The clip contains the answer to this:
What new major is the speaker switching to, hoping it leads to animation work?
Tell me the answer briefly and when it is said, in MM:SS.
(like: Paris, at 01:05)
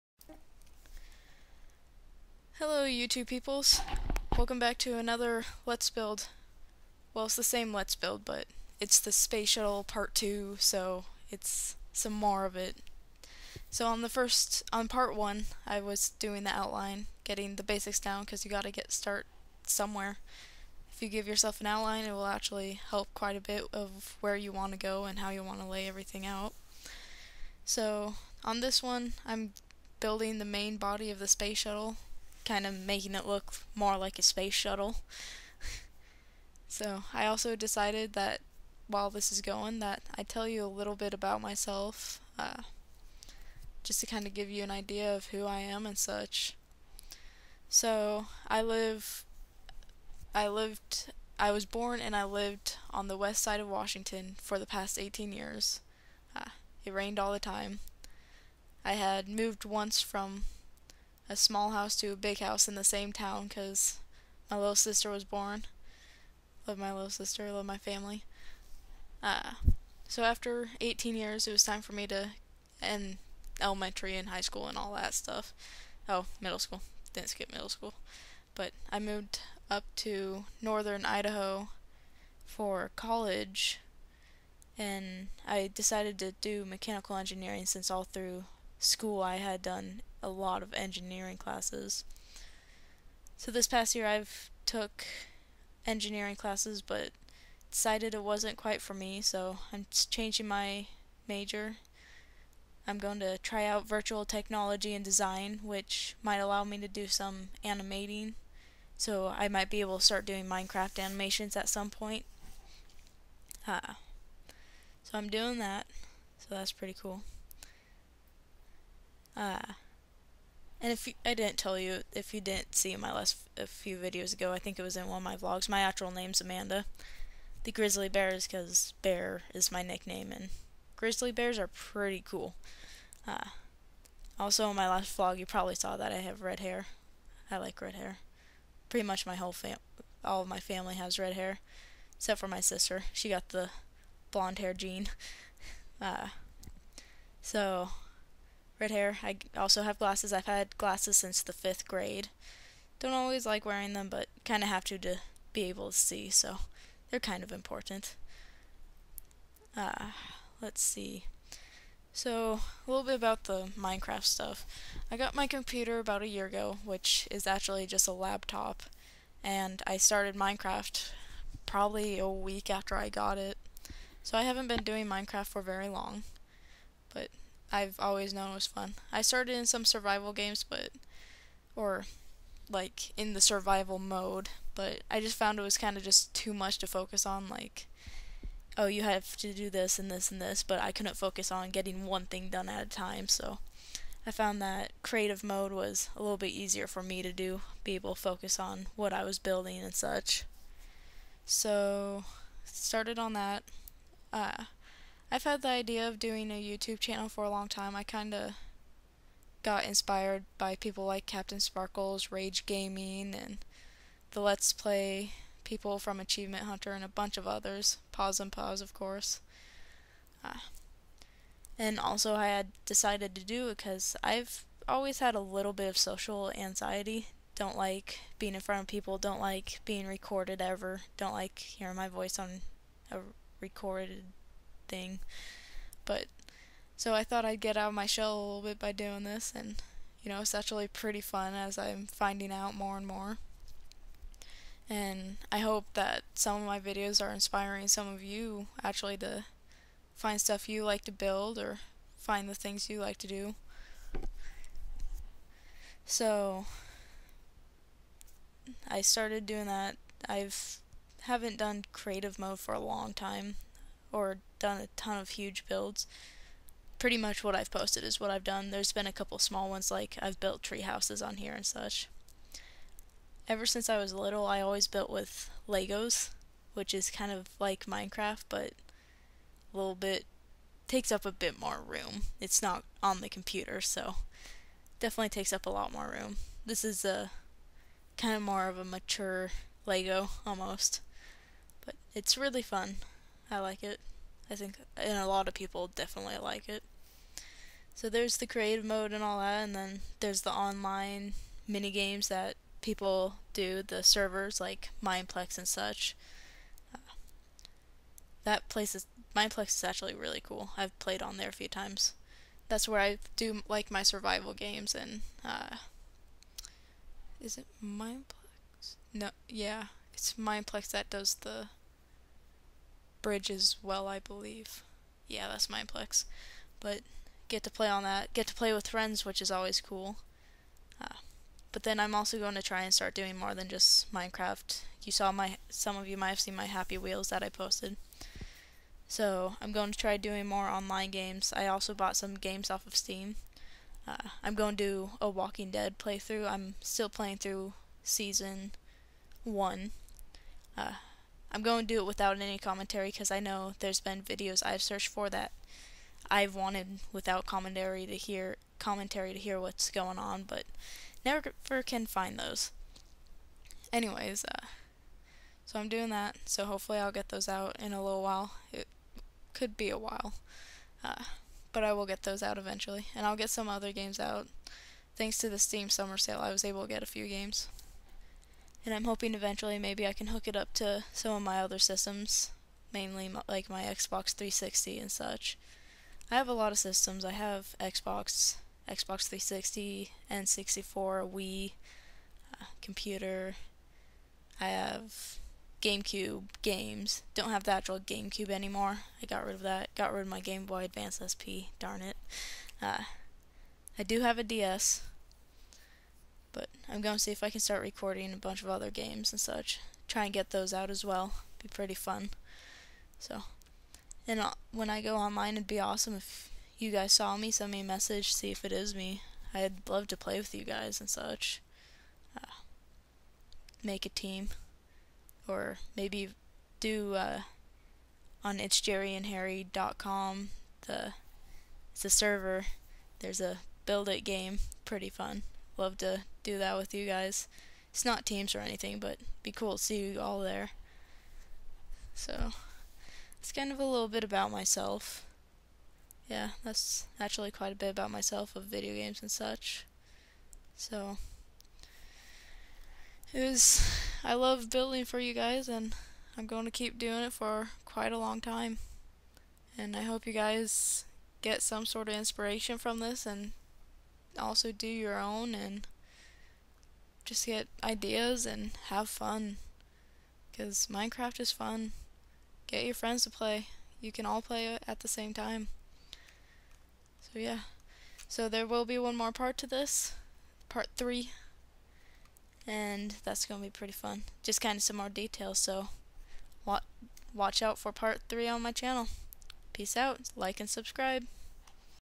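Virtual technology and design, at 01:43.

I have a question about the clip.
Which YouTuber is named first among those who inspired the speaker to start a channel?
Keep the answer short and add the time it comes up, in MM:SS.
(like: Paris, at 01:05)
CaptainSparklez, at 03:31.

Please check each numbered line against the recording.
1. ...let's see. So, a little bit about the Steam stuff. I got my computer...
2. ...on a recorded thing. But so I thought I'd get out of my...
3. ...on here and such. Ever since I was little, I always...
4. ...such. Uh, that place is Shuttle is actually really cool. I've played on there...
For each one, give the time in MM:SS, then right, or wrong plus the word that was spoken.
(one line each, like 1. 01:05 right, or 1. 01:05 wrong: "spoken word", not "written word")
1. 02:40 wrong: "Minecraft", not "Steam"
2. 03:52 right
3. 04:31 right
4. 05:05 wrong: "Mineplex", not "Shuttle".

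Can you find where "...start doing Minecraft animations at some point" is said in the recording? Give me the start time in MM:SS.
01:50.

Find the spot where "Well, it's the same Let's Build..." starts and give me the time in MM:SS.
00:07.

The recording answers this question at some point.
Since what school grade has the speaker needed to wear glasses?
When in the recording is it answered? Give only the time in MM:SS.
02:31.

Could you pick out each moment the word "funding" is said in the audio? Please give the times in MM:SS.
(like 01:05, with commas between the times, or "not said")
not said.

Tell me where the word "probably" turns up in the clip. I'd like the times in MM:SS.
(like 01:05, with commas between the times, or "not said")
02:15, 02:51.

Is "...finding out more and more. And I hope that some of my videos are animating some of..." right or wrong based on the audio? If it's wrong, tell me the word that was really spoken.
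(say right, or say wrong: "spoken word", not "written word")
wrong: "inspiring", not "animating".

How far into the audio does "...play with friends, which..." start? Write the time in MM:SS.
05:28.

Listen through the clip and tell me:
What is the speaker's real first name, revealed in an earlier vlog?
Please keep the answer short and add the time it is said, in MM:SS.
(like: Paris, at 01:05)
Amanda, at 02:06.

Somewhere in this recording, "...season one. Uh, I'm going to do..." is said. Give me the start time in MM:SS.
05:48.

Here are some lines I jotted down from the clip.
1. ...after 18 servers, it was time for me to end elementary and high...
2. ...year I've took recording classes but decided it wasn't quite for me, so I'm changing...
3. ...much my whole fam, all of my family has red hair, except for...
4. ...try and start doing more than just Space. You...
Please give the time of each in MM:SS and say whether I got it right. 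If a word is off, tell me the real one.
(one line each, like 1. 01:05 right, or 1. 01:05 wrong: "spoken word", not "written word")
1. 01:10 wrong: "years", not "servers"
2. 01:33 wrong: "engineering", not "recording"
3. 02:19 right
4. 05:32 wrong: "Minecraft", not "Space".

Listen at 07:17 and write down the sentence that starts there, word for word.
It's not teams or anything, but be cool to see you all there.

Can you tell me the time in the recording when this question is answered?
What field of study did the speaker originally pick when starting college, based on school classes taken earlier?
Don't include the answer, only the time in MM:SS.
01:26.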